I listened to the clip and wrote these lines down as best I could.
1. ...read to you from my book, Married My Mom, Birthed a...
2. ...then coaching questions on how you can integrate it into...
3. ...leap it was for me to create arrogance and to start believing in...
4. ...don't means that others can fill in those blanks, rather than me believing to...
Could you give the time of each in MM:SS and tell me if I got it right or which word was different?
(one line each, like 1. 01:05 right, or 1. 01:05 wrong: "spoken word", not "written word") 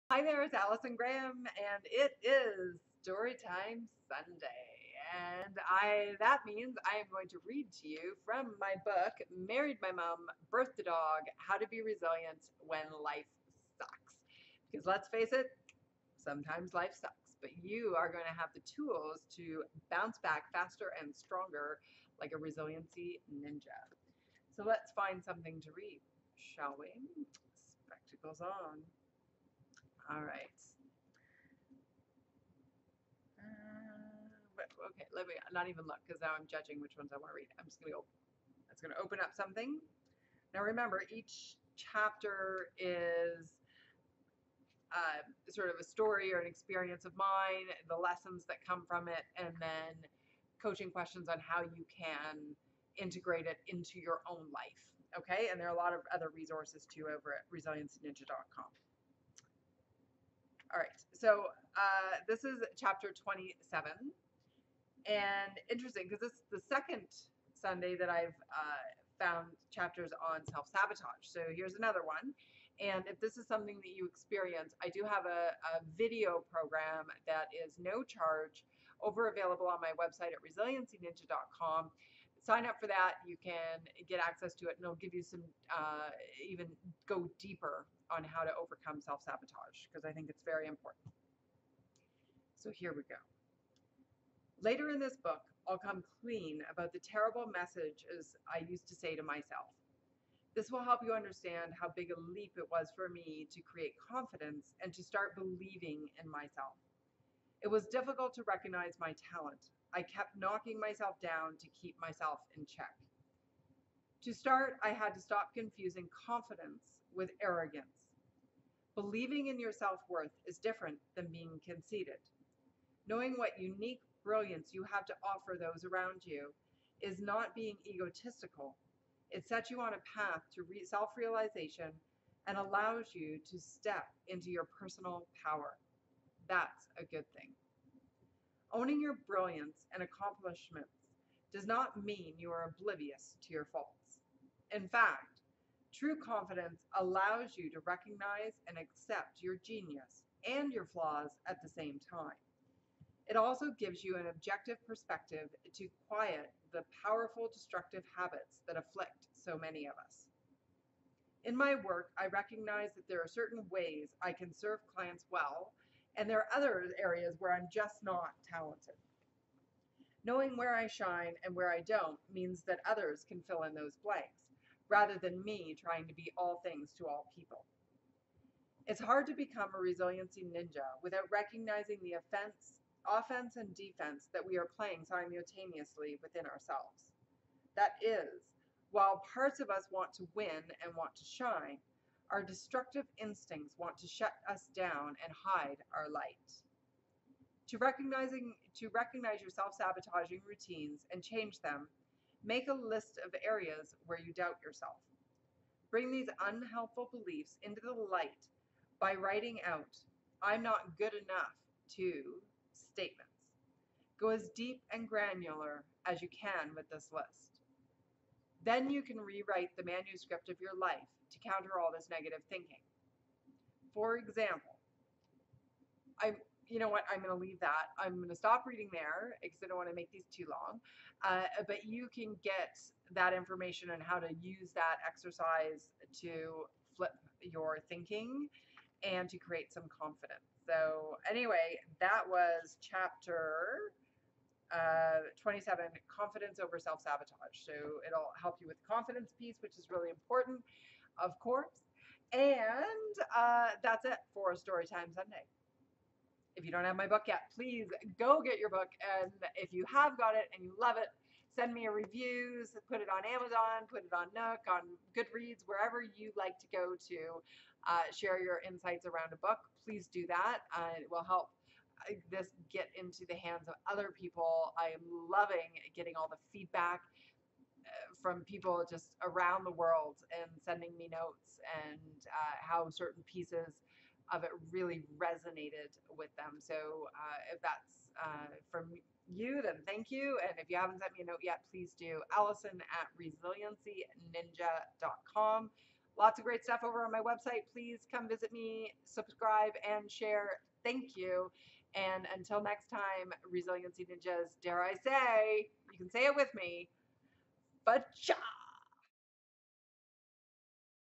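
1. 00:07 right
2. 00:49 right
3. 01:42 wrong: "confidence", not "arrogance"
4. 02:51 wrong: "trying", not "believing".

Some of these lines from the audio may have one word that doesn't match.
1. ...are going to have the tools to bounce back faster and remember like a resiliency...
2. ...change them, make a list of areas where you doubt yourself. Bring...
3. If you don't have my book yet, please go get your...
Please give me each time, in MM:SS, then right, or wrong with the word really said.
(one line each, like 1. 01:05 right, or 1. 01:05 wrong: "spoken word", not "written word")
1. 00:17 wrong: "stronger", not "remember"
2. 03:21 right
3. 04:16 right.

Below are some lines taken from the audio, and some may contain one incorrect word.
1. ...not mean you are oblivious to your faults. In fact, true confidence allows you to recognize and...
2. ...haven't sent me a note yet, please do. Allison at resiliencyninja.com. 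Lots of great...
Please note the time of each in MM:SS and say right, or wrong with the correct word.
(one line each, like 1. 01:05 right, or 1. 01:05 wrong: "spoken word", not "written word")
1. 02:21 right
2. 04:50 right.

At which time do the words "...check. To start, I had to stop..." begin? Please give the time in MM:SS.
01:52.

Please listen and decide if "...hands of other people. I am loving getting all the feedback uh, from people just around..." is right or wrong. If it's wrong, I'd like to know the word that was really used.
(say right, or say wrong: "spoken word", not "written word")
right.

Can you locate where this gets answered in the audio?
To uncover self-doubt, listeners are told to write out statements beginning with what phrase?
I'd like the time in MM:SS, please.
03:30.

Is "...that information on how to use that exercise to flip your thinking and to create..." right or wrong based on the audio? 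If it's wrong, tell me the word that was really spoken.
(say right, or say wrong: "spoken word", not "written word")
right.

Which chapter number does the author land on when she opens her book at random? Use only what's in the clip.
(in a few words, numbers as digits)
27.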